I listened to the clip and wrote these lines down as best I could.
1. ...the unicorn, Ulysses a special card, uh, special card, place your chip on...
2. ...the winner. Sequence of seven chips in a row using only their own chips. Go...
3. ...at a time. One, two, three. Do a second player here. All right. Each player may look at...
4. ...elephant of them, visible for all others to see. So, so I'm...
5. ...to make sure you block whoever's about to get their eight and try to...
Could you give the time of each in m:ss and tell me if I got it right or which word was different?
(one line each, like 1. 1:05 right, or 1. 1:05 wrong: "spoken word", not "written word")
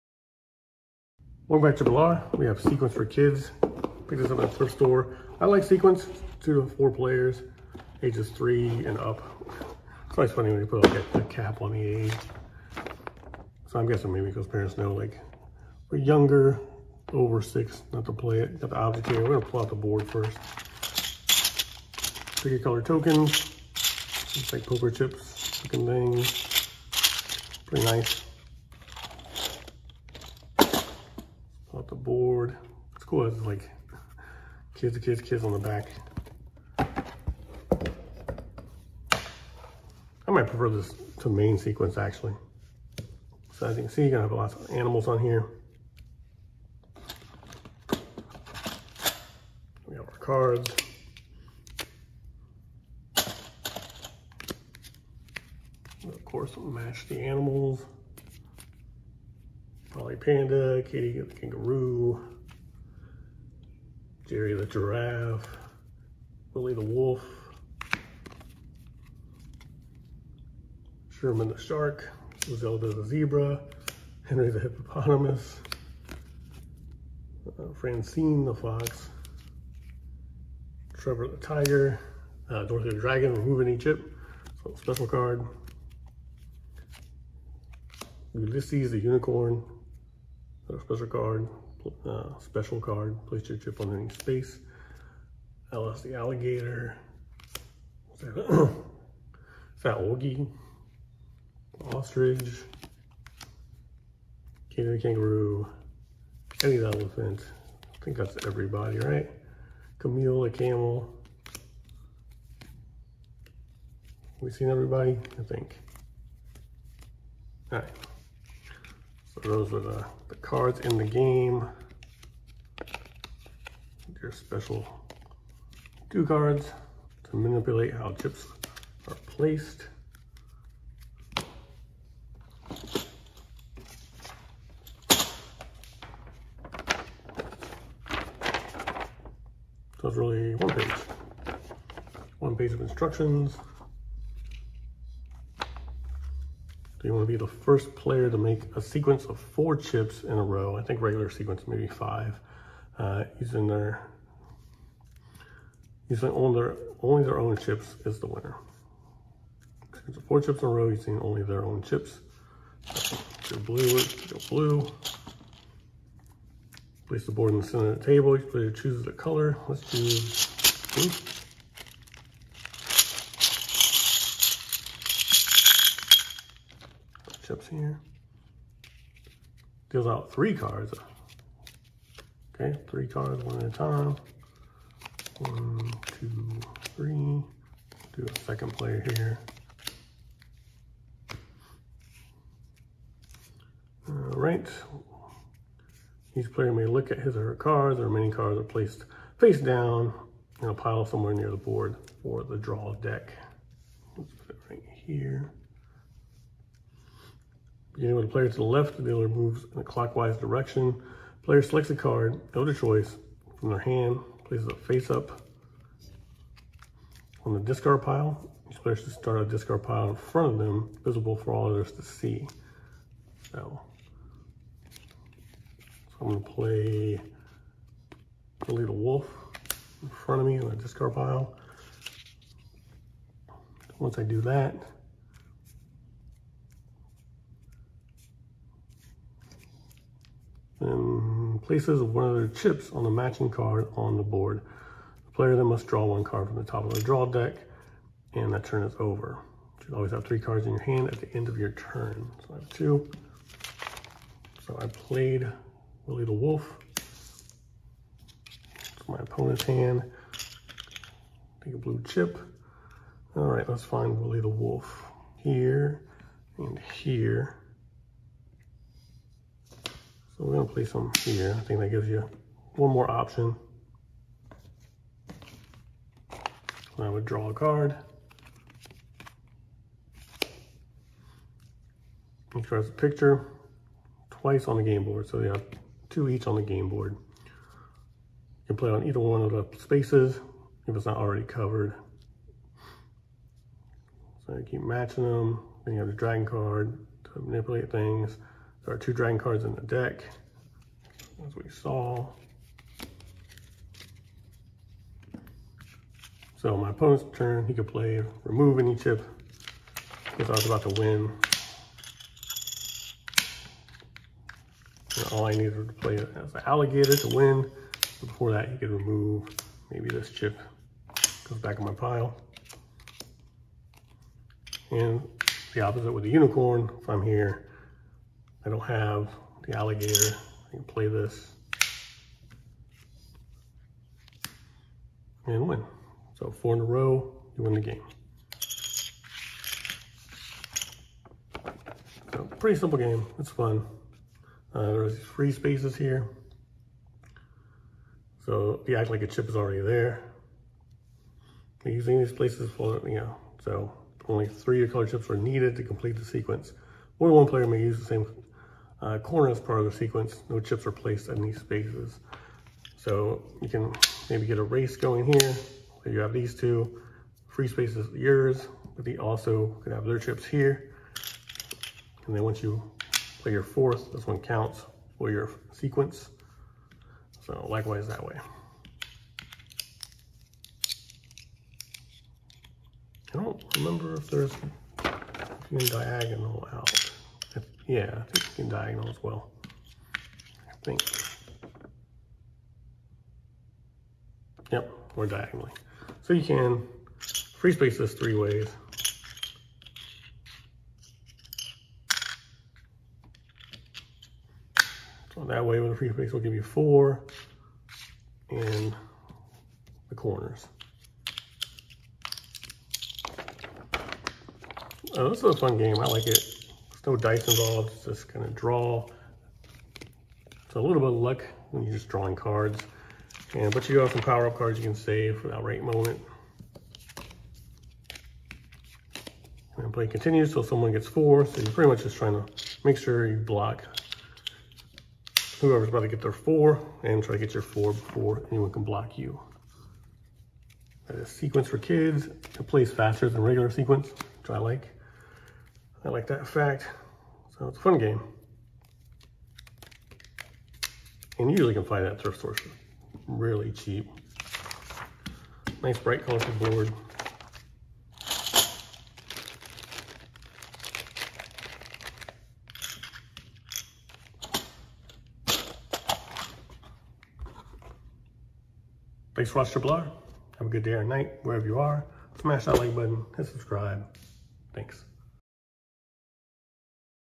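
1. 1:28 wrong: "Put", not "Ulysses"
2. 2:38 wrong: "four", not "seven"
3. 3:03 right
4. 3:40 wrong: "front", not "elephant"
5. 7:12 wrong: "four", not "eight".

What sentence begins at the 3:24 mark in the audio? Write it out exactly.
Let's put it right here beginning with the player to the left, the dealer moves in a clockwise direction.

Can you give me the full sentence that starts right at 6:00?
No chips are placed in these spaces.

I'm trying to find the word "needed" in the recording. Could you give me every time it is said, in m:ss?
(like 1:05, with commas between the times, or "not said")
5:15, 5:55.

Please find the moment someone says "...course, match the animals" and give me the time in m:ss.
0:56.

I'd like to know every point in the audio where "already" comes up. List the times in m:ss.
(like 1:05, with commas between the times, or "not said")
4:51, 5:49.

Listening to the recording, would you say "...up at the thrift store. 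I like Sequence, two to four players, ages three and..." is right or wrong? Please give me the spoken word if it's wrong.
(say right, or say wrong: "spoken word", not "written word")
right.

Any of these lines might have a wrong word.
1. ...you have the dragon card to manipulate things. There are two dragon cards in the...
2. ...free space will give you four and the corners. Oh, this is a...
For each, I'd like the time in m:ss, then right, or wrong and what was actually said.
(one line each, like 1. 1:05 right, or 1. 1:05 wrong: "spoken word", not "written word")
1. 4:55 right
2. 6:45 right.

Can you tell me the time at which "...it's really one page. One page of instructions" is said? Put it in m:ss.
2:20.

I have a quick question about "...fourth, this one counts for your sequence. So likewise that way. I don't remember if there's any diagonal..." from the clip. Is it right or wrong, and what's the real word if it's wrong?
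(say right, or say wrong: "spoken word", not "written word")
right.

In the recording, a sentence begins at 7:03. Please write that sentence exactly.
And but you have some power-up cards you can save for that right moment.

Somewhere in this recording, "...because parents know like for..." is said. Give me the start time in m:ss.
0:14.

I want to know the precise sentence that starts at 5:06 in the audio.
So my opponent's turn, he could play remove any chip because I was about to win.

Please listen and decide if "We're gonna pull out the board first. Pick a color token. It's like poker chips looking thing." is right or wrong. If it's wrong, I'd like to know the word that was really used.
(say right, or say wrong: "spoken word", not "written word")
right.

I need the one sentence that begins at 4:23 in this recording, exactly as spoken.
All right, let's find Willie the Wolf here and here.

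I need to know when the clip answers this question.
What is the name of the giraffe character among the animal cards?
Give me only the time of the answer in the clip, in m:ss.
1:04.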